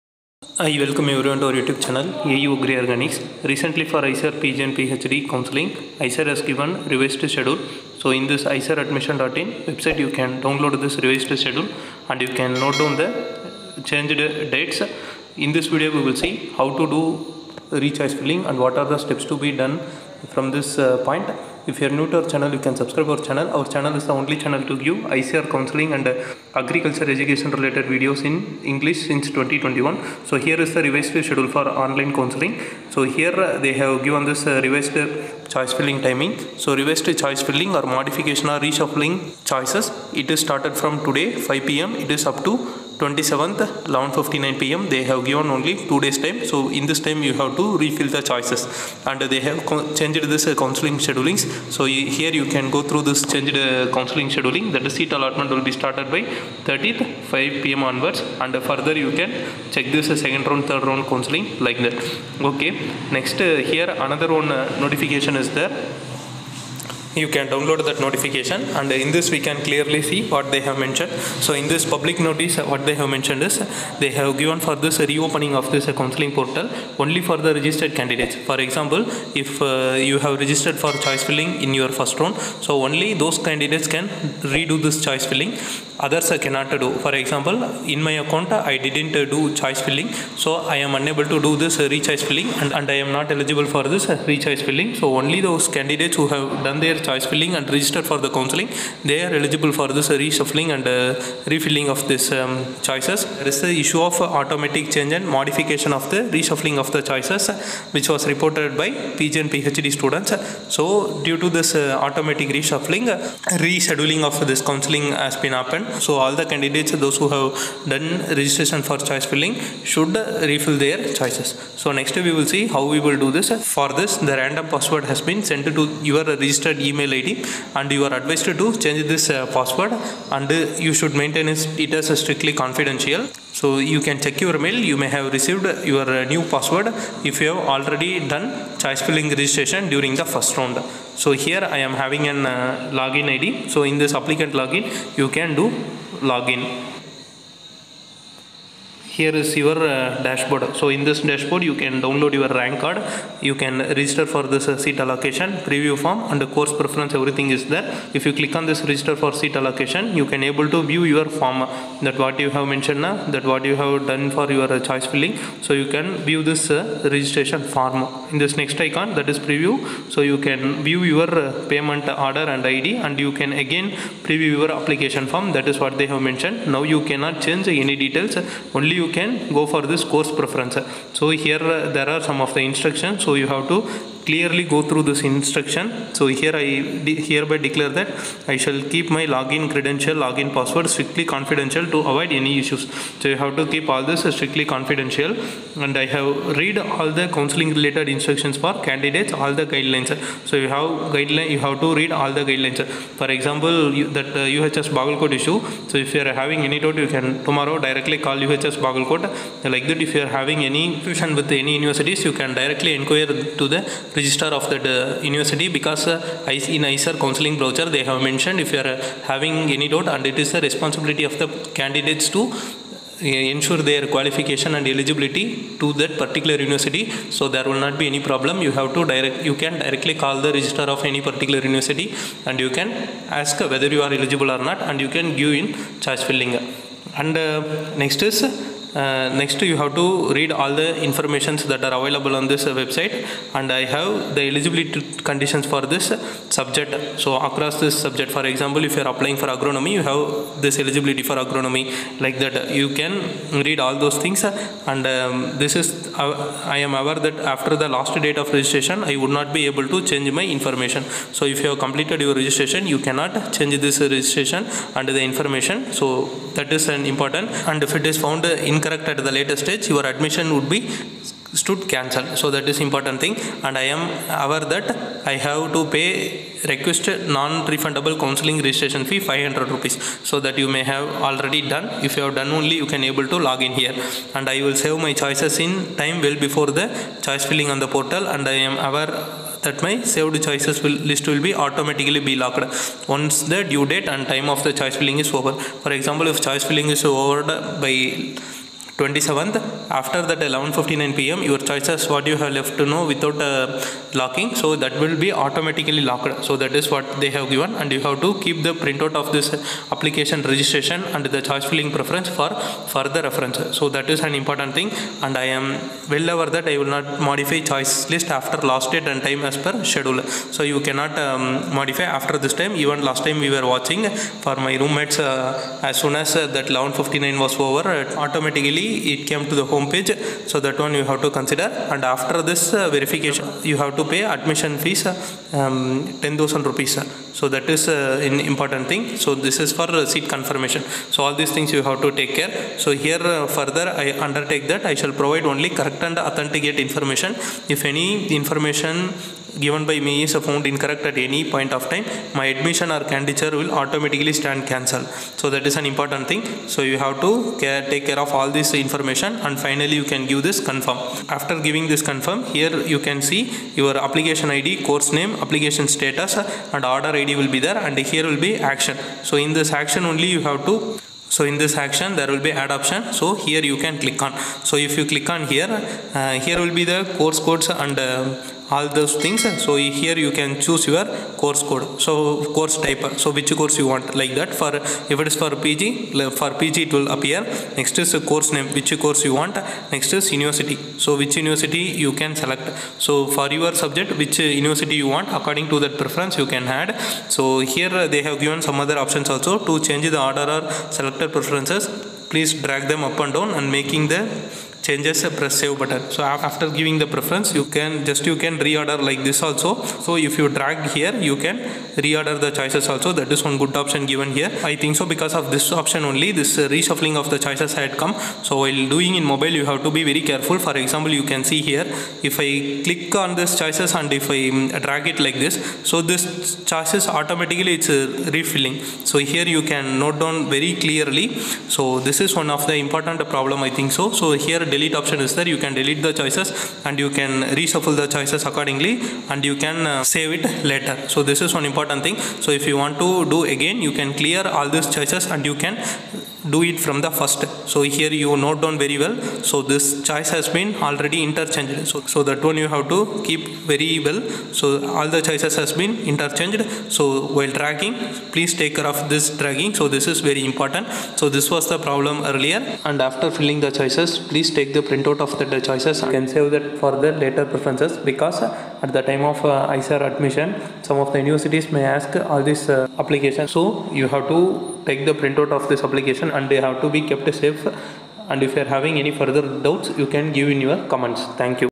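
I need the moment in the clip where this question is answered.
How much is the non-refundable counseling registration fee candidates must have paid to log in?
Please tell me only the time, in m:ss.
4:39.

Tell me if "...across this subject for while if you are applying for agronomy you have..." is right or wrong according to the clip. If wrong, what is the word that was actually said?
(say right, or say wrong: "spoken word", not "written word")
wrong: "example", not "while".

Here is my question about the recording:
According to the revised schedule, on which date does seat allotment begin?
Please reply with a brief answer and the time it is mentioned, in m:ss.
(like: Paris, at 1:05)
30th, at 0:56.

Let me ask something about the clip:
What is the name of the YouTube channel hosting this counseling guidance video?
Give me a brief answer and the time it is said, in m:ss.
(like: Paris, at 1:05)
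AU Agri Organics, at 0:02.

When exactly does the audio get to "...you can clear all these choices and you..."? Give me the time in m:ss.
7:23.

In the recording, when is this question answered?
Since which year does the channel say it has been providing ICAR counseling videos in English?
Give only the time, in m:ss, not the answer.
0:29.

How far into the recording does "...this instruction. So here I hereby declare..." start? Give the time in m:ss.
3:05.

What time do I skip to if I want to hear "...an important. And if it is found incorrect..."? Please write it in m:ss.
4:26.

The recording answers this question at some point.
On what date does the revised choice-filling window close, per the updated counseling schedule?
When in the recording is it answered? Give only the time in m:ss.
0:43.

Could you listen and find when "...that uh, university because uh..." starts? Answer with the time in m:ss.
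3:34.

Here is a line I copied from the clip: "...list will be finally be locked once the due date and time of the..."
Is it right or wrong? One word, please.
wrong.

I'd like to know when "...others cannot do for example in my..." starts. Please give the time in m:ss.
1:25.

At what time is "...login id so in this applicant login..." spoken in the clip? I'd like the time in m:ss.
2:23.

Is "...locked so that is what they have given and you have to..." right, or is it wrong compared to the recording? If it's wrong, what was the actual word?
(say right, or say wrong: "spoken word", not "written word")
right.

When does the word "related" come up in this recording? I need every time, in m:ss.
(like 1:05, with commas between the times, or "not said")
0:27, 3:17.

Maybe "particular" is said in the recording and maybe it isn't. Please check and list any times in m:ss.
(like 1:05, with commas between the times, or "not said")
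3:46, 3:51.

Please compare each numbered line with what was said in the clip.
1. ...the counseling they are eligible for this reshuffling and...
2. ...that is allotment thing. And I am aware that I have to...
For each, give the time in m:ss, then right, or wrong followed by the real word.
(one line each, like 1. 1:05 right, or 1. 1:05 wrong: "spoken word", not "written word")
1. 1:38 right
2. 4:32 wrong: "important", not "allotment".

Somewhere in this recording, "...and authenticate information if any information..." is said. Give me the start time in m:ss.
5:46.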